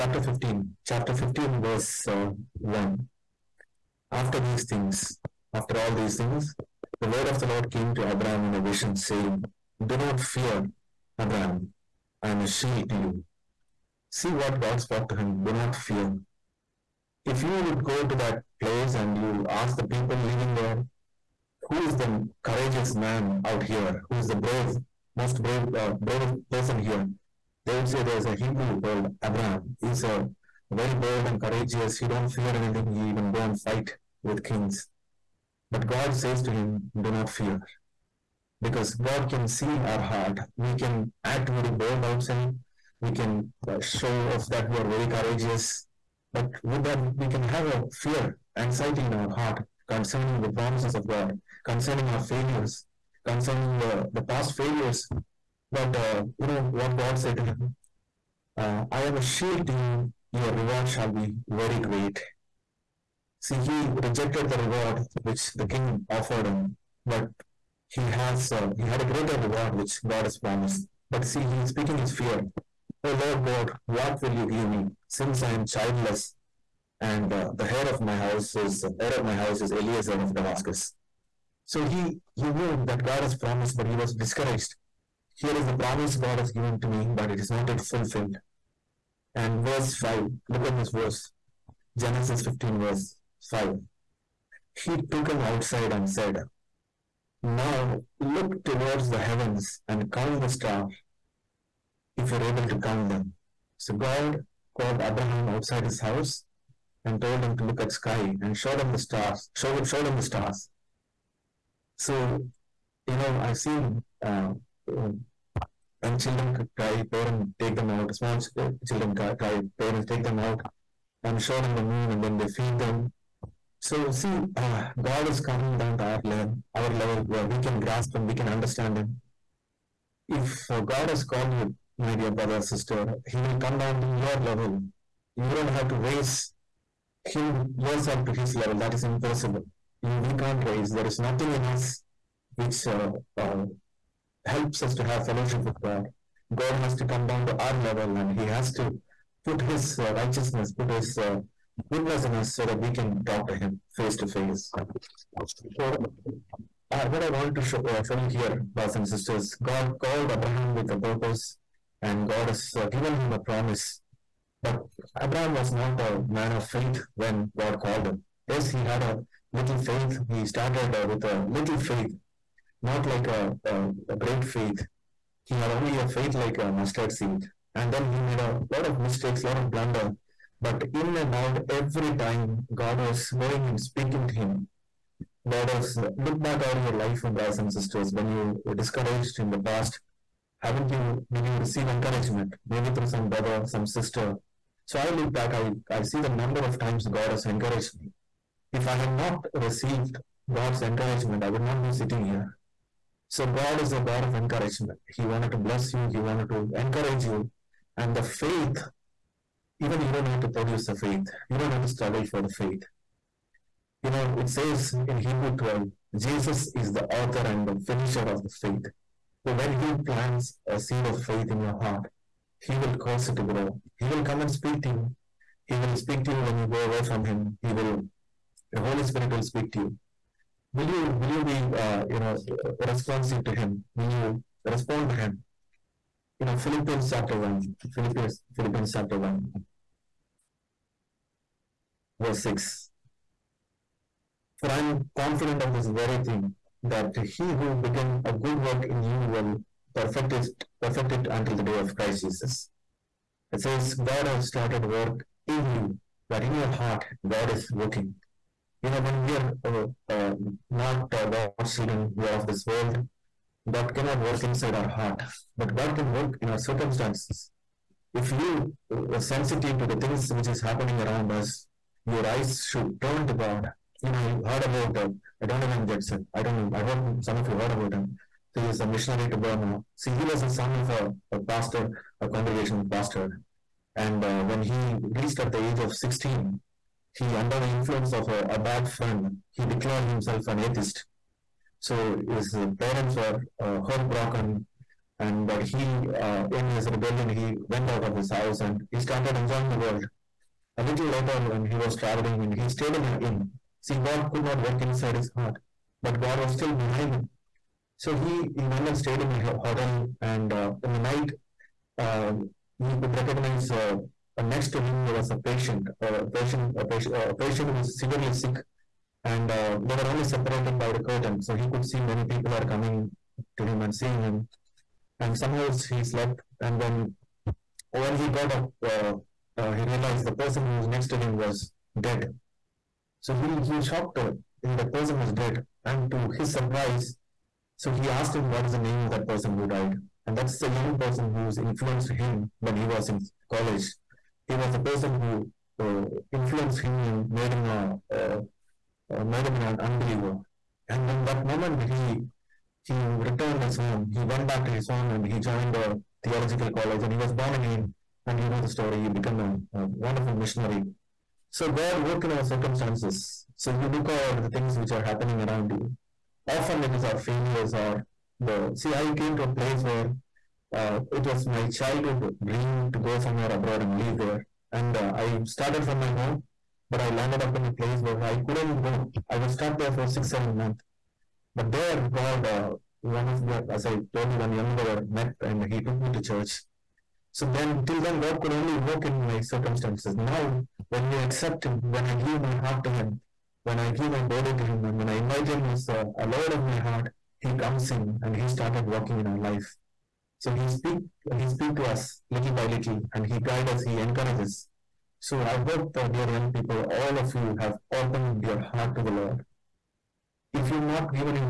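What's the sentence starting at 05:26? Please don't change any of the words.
And when when he got up, uh, uh, he realized the person who was next to him was dead.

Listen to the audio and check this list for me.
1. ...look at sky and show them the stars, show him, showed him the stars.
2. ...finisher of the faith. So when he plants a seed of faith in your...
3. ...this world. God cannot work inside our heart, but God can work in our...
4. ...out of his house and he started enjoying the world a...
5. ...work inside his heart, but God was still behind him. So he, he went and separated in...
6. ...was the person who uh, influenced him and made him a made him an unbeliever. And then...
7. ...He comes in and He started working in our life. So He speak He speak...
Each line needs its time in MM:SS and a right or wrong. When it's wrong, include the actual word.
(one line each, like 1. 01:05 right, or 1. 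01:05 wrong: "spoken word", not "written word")
1. 01:47 right
2. 03:37 right
3. 04:22 right
4. 04:57 right
5. 05:04 wrong: "stayed", not "separated"
6. 05:44 right
7. 06:37 right.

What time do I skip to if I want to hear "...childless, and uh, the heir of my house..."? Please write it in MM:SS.
01:15.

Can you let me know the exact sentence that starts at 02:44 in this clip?
But Abraham was not a man of faith when God called him.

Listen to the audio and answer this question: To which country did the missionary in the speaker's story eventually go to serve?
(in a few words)
Burma.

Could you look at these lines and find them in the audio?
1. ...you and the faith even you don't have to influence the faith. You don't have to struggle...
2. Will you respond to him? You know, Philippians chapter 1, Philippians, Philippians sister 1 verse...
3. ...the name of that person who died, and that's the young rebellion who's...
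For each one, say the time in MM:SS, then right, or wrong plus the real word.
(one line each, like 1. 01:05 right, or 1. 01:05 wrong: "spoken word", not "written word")
1. 03:27 wrong: "produce", not "influence"
2. 03:53 wrong: "chapter", not "sister"
3. 05:38 wrong: "person", not "rebellion".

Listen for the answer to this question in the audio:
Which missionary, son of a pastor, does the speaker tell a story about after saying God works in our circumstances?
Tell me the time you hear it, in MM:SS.
04:35.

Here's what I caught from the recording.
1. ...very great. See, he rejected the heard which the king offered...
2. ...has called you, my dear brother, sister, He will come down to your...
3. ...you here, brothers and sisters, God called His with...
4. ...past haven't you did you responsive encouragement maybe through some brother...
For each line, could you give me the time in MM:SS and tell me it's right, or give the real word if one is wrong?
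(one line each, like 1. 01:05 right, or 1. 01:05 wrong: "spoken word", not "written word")
1. 01:01 wrong: "reward", not "heard"
2. 02:11 right
3. 02:38 wrong: "Abraham", not "His"
4. 03:09 wrong: "receive", not "responsive".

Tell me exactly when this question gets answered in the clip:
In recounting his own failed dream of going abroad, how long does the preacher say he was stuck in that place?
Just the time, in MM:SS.
06:20.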